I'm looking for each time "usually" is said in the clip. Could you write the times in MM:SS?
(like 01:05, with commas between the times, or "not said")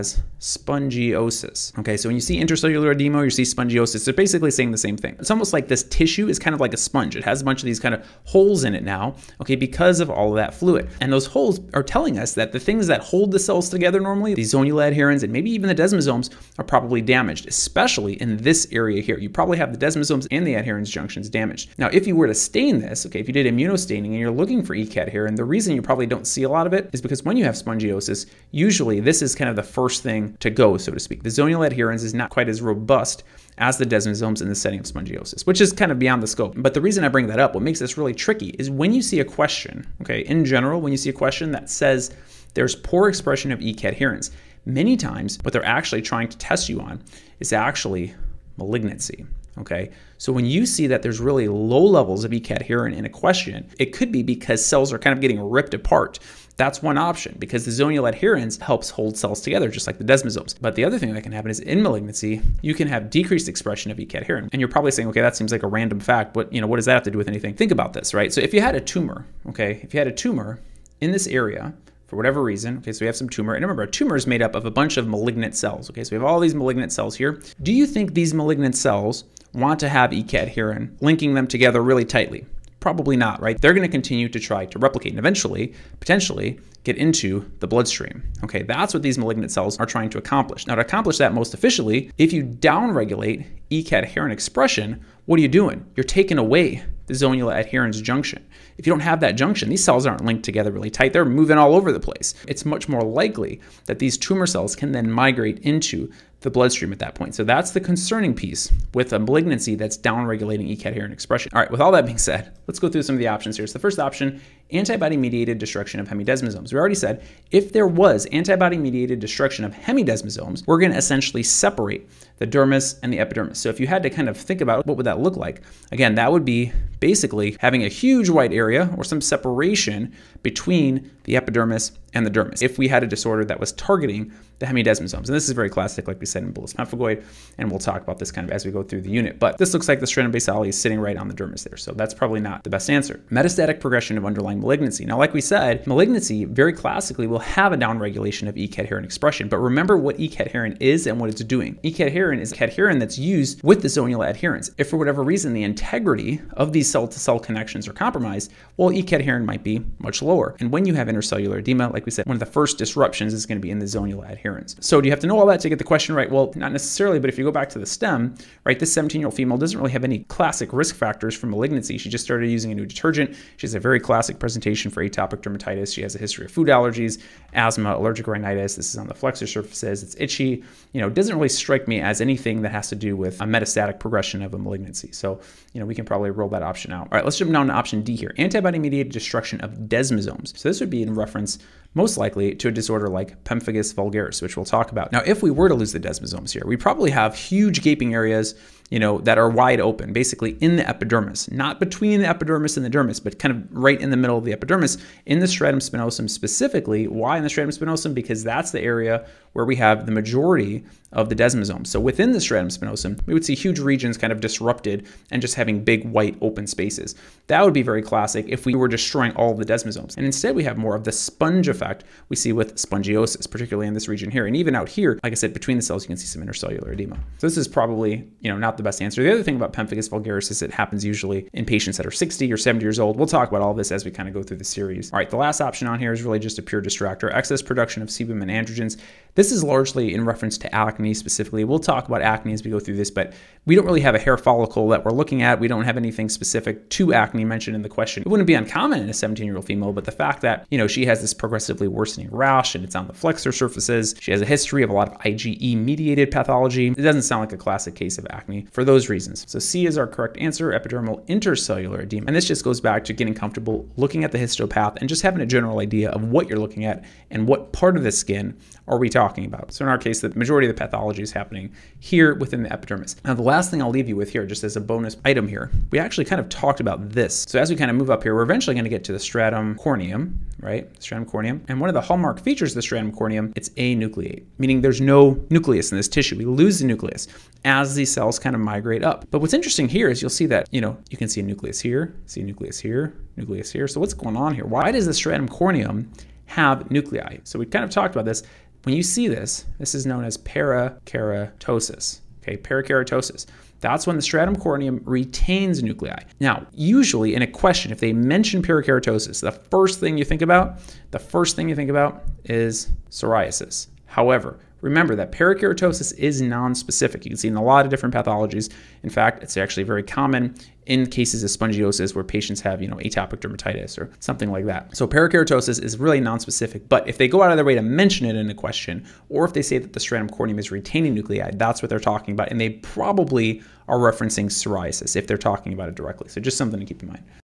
00:28, 03:51, 05:06.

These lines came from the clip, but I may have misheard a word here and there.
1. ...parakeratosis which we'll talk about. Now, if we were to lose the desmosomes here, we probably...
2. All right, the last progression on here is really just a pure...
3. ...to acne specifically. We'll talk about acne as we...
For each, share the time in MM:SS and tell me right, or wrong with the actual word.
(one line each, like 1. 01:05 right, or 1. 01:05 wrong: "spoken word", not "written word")
1. 03:13 wrong: "vulgaris", not "parakeratosis"
2. 03:55 wrong: "option", not "progression"
3. 04:00 right.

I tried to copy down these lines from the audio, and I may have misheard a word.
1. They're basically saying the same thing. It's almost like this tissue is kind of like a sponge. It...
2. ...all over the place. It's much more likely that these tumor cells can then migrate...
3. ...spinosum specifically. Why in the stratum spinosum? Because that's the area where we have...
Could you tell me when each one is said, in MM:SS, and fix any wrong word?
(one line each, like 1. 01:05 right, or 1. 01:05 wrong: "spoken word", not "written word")
1. 00:04 right
2. 01:41 right
3. 03:25 right.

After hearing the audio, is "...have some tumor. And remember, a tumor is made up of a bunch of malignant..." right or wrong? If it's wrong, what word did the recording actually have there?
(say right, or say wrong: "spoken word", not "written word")
right.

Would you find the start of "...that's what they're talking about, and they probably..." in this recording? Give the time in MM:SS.
05:31.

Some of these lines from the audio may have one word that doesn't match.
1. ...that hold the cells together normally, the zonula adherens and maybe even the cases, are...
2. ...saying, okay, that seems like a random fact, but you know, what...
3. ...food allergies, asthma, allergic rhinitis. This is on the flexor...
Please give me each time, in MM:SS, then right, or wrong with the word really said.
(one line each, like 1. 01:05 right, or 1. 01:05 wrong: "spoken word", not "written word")
1. 00:12 wrong: "desmosomes", not "cases"
2. 01:04 right
3. 02:56 right.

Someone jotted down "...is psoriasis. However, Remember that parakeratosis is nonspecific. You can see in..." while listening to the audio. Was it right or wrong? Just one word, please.
right.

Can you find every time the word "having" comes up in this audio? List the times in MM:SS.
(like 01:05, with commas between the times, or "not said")
02:07, 03:35, 04:25.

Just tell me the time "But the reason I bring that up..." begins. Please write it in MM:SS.
00:36.